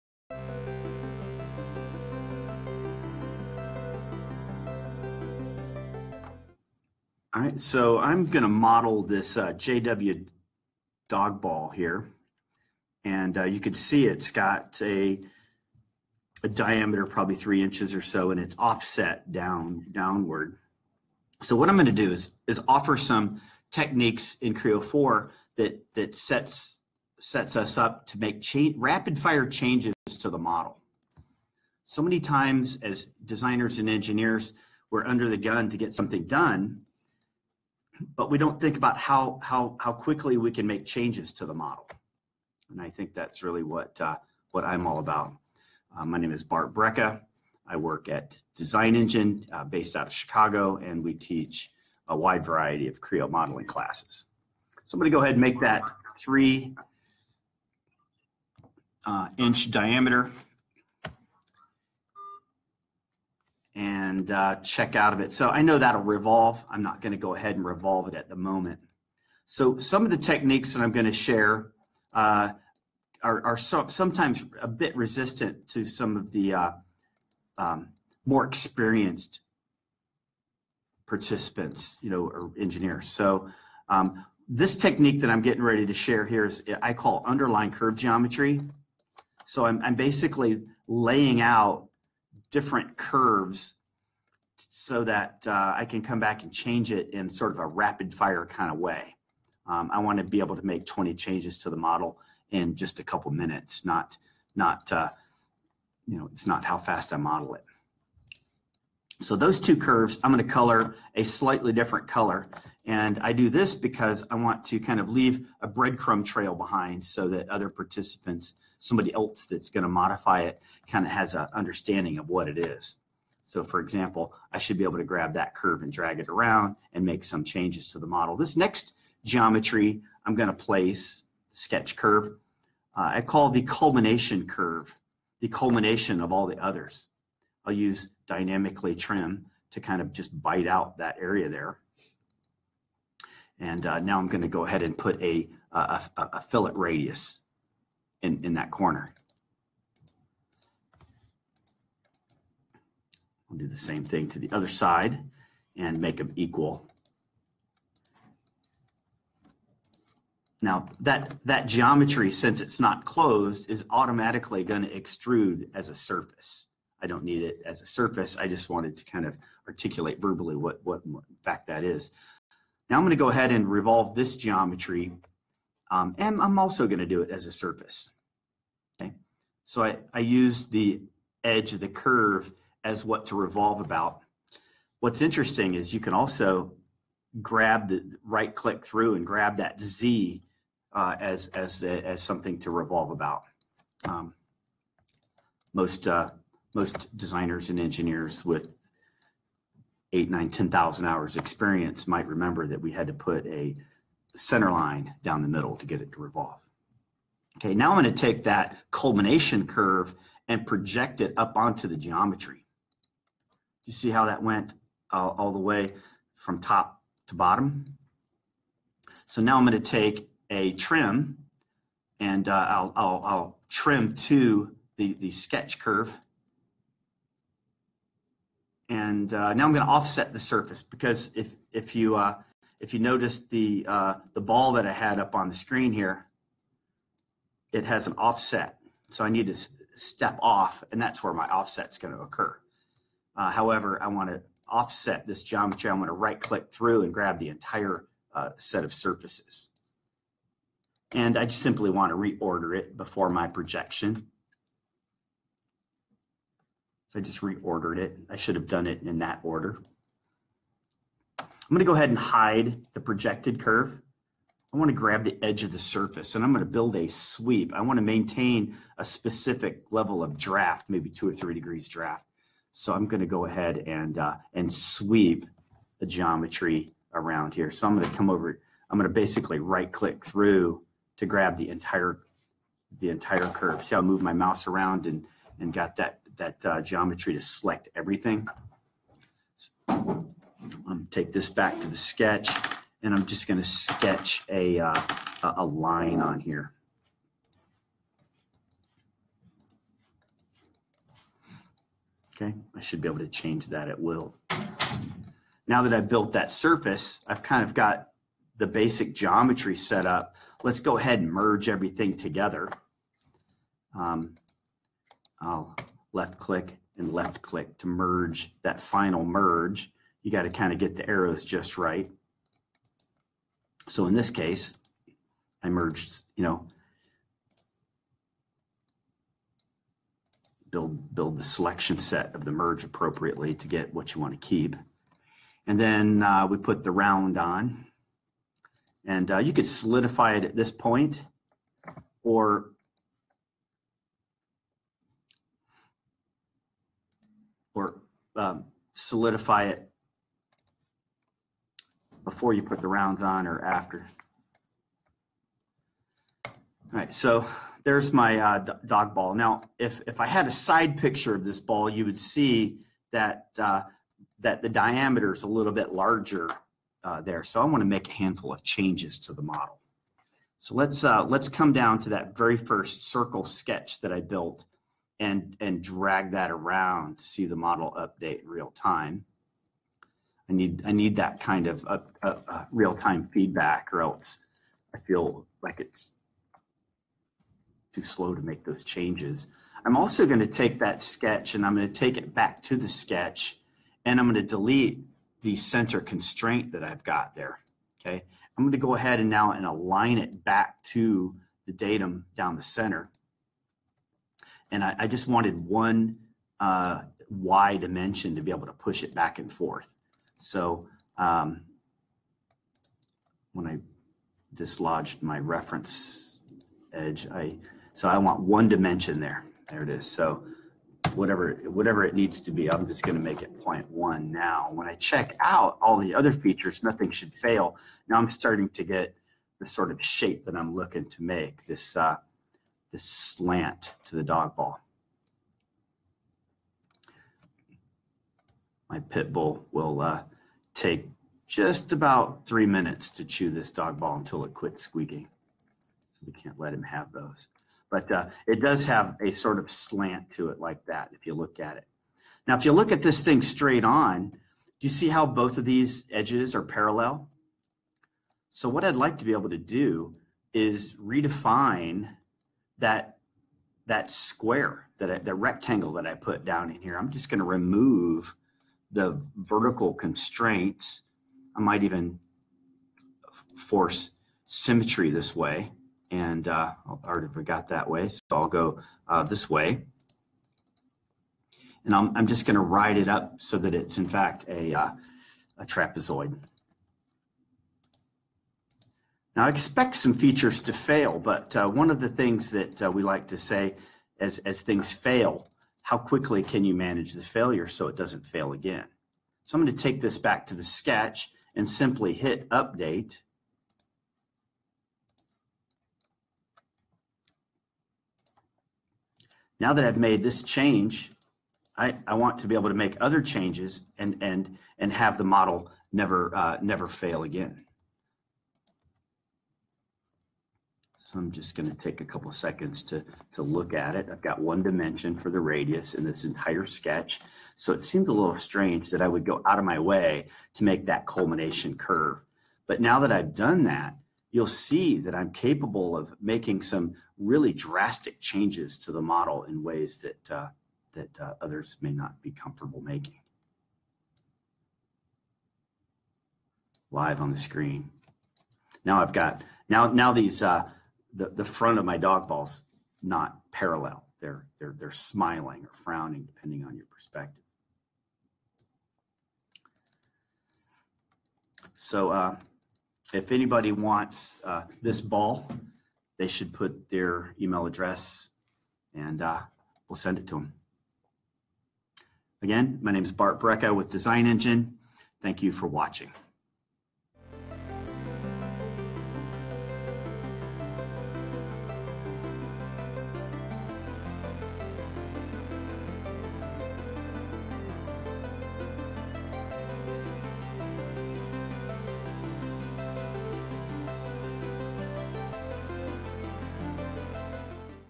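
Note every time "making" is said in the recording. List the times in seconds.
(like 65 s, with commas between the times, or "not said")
536 s, 542 s.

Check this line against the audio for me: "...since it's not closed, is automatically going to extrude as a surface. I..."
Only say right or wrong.
right.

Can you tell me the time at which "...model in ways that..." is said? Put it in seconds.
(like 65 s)
539 s.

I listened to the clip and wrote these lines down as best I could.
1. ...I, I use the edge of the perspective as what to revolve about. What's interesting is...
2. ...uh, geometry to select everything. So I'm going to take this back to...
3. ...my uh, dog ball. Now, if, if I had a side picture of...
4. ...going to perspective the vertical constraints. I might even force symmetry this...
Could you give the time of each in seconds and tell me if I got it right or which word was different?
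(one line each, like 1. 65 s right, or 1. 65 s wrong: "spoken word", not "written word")
1. 179 s wrong: "curve", not "perspective"
2. 286 s right
3. 358 s right
4. 467 s wrong: "remove", not "perspective".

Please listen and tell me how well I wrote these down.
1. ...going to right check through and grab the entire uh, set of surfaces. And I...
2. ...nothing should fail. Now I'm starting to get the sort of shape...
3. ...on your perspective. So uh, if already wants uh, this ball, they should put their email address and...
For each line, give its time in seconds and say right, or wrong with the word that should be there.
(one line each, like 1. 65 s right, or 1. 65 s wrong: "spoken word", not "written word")
1. 245 s wrong: "click", not "check"
2. 426 s right
3. 556 s wrong: "anybody", not "already".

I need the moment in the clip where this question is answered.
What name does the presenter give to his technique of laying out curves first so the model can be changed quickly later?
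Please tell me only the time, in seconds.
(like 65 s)
87 s.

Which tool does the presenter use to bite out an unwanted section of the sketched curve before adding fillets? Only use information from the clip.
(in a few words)
dynamically trim.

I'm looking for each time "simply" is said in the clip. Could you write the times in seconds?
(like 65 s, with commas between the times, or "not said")
251 s, 501 s.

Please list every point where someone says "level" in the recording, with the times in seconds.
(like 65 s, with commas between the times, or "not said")
269 s.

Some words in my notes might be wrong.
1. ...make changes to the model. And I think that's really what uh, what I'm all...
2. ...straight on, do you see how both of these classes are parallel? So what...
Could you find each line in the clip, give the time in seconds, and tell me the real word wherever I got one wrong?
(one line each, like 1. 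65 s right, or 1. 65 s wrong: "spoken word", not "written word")
1. 40 s right
2. 453 s wrong: "edges", not "classes".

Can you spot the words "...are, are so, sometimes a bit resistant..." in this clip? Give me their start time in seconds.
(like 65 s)
73 s.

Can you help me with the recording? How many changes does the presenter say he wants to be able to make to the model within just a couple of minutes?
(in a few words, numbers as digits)
20.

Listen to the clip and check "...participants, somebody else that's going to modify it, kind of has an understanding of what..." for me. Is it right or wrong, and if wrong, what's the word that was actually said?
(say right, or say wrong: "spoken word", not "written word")
right.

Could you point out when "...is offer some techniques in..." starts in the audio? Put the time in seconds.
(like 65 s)
22 s.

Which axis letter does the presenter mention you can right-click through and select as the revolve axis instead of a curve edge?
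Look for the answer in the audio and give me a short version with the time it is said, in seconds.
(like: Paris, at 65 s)
Z, at 189 s.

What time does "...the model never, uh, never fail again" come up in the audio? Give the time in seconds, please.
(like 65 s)
515 s.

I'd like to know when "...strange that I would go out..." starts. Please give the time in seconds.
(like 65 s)
528 s.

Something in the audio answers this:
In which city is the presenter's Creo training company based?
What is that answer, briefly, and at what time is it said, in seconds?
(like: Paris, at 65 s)
Chicago, at 50 s.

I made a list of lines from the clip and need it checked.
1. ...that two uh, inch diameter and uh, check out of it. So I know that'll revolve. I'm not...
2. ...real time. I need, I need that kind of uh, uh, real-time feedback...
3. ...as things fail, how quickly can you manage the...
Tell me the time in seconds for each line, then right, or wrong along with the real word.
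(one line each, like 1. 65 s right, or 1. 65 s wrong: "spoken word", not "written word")
1. 55 s wrong: "three", not "two"
2. 378 s right
3. 494 s right.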